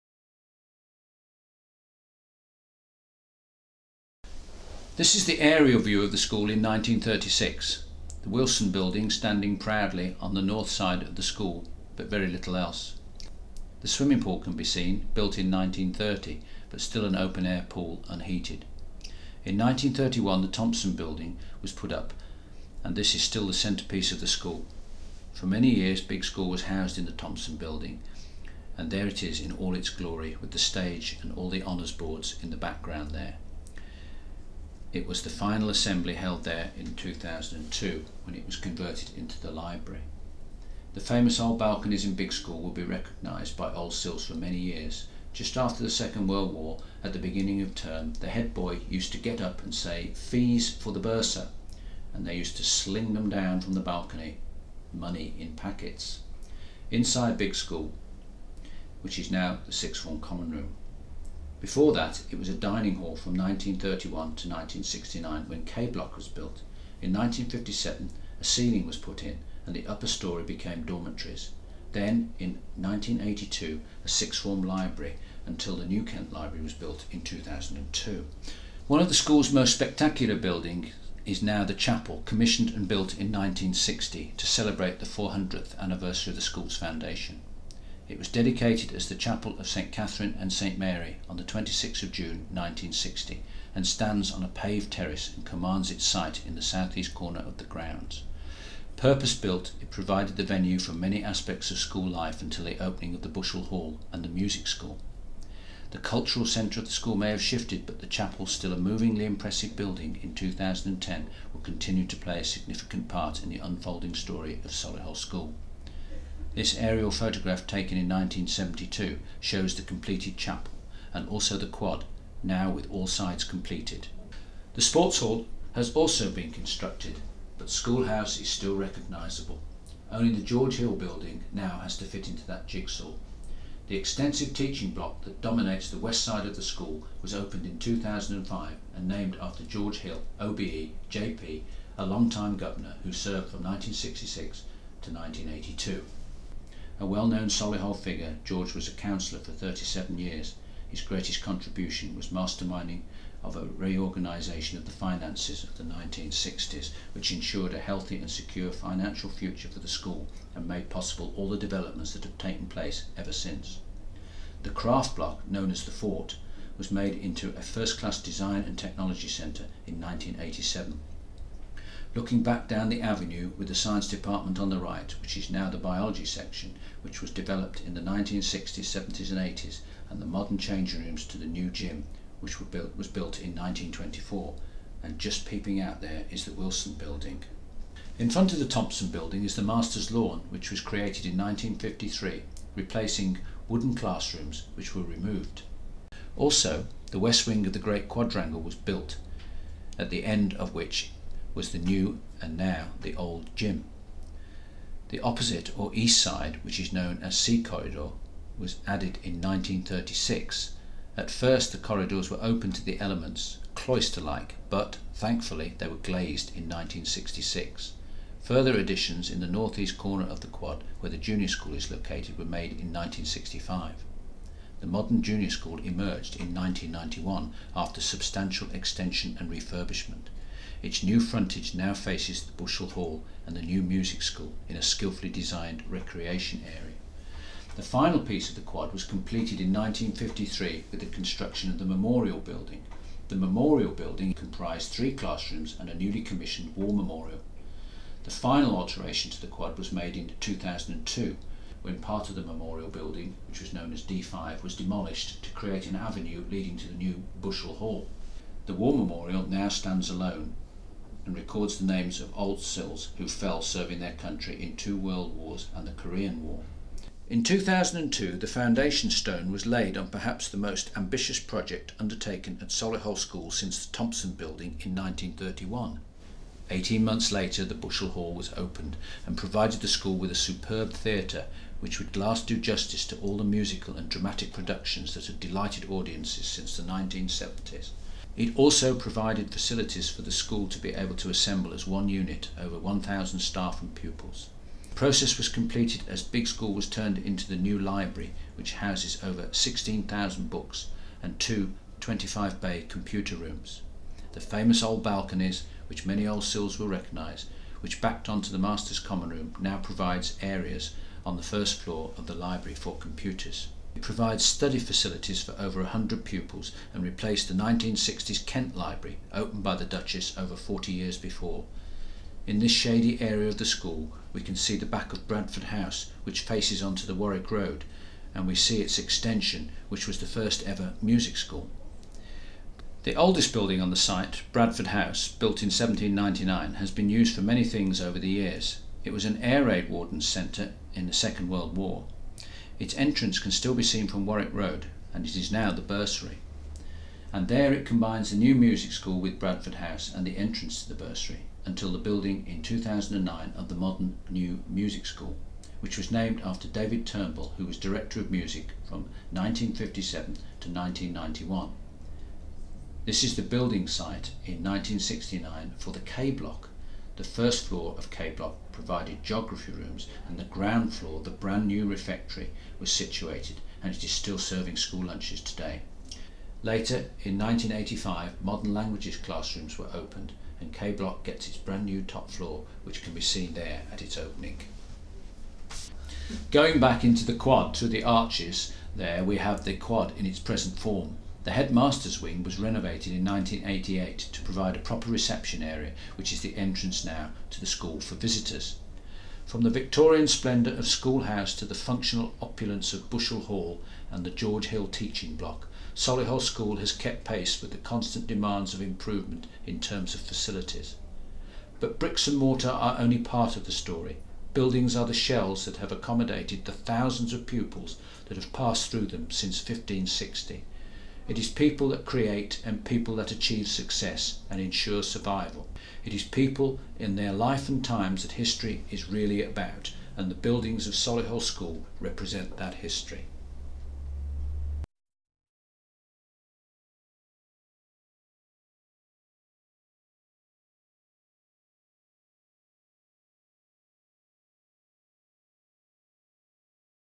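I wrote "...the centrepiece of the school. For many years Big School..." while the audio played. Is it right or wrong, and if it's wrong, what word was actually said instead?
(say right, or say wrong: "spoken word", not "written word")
right.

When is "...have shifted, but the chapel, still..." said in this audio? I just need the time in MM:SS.
01:47.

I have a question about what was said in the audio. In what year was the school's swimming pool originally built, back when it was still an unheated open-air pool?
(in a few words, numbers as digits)
1930.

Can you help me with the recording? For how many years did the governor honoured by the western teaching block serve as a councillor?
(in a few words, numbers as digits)
37.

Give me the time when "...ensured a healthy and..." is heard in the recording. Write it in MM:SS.
02:37.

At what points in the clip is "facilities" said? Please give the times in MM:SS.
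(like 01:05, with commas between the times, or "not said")
04:49, 05:14, 06:50.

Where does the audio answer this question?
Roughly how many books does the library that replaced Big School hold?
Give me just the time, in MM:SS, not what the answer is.
04:59.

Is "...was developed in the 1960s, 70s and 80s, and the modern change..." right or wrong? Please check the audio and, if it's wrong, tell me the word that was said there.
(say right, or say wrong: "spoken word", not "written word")
right.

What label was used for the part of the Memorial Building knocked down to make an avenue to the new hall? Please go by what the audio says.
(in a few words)
D5.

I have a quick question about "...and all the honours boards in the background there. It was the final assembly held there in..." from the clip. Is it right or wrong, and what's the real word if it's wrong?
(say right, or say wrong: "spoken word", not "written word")
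right.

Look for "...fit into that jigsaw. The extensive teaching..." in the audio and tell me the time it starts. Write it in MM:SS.
02:12.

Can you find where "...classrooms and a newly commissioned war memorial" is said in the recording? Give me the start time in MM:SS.
04:05.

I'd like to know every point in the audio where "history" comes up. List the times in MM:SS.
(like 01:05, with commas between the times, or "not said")
07:08, 07:12.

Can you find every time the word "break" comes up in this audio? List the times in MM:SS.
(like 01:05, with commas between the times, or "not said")
not said.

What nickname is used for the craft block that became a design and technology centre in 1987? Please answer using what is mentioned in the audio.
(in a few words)
The Fort.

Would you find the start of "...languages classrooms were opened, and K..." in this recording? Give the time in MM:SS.
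06:18.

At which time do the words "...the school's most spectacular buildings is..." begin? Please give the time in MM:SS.
01:19.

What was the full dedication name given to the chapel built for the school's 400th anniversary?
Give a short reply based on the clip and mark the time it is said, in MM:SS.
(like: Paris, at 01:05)
Chapel of St Catherine and St Mary, at 01:29.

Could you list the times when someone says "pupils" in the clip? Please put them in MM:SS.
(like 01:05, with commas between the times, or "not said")
04:53, 05:16, 06:57.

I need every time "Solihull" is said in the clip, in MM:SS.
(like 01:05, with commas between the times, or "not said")
01:54, 02:27, 04:32, 06:45, 07:10.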